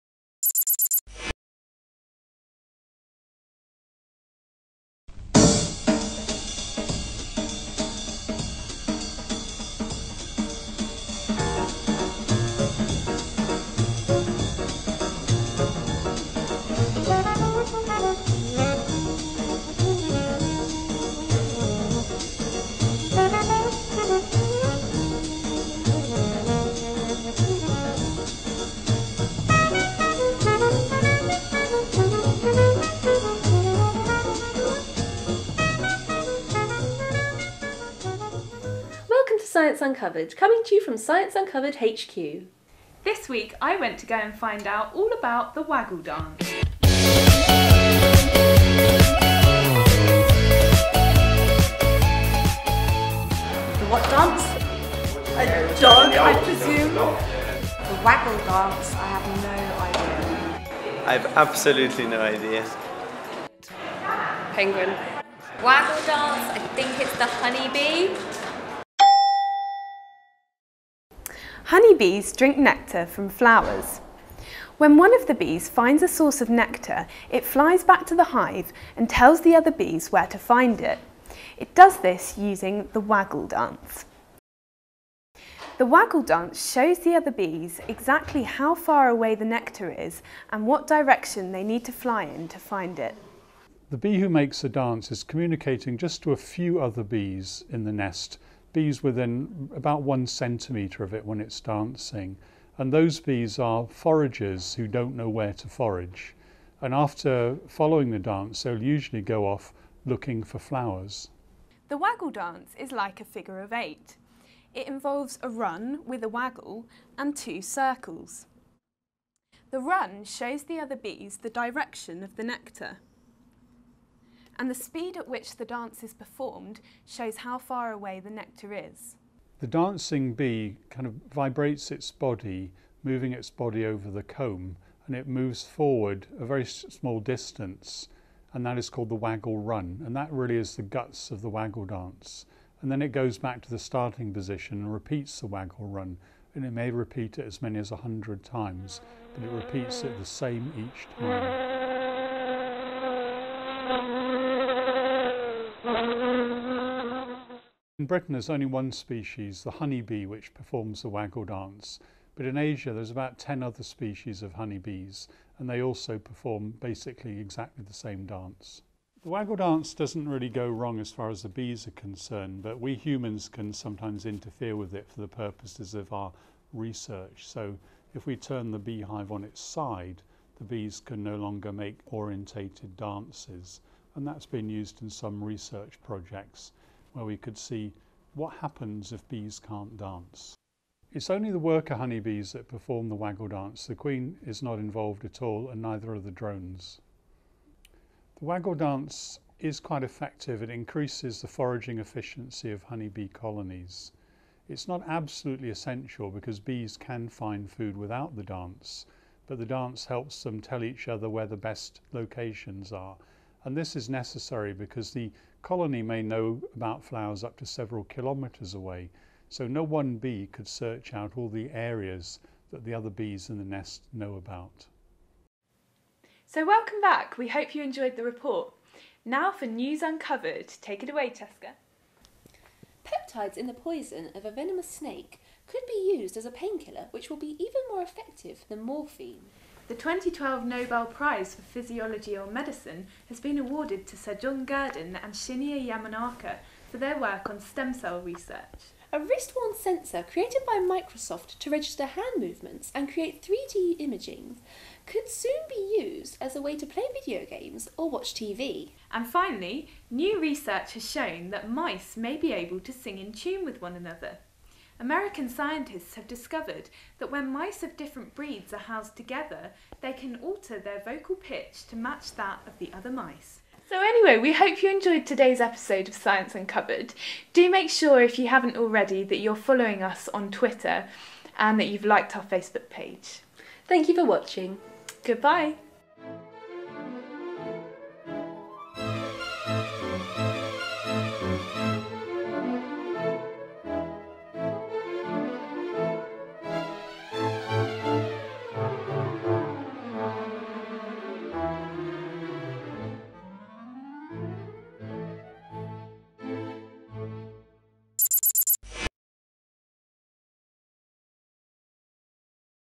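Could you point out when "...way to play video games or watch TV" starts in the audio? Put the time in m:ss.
4:16.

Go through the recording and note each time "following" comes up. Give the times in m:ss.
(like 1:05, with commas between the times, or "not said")
1:47, 4:39.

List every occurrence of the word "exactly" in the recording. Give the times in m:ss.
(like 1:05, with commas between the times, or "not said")
1:27, 2:47.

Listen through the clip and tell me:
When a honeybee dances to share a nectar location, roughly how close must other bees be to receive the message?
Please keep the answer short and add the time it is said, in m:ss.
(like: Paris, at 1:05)
1 centimetre, at 1:40.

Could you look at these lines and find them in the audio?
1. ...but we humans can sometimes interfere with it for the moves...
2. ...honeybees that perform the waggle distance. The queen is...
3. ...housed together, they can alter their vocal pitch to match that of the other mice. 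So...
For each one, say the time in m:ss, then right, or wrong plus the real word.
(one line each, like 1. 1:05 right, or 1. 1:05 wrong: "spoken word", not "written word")
1. 2:52 wrong: "purposes", not "moves"
2. 3:11 wrong: "dance", not "distance"
3. 4:28 right.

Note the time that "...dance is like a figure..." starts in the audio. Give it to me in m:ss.
1:52.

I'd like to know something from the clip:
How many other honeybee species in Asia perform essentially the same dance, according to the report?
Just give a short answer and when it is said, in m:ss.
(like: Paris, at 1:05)
About 10, at 2:43.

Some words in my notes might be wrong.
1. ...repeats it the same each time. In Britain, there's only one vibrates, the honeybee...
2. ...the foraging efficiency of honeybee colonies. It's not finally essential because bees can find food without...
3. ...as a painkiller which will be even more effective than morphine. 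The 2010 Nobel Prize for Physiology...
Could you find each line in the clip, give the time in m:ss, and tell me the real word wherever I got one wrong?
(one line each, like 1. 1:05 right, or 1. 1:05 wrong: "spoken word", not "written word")
1. 2:29 wrong: "species", not "vibrates"
2. 3:21 wrong: "absolutely", not "finally"
3. 3:56 wrong: "2012", not "2010".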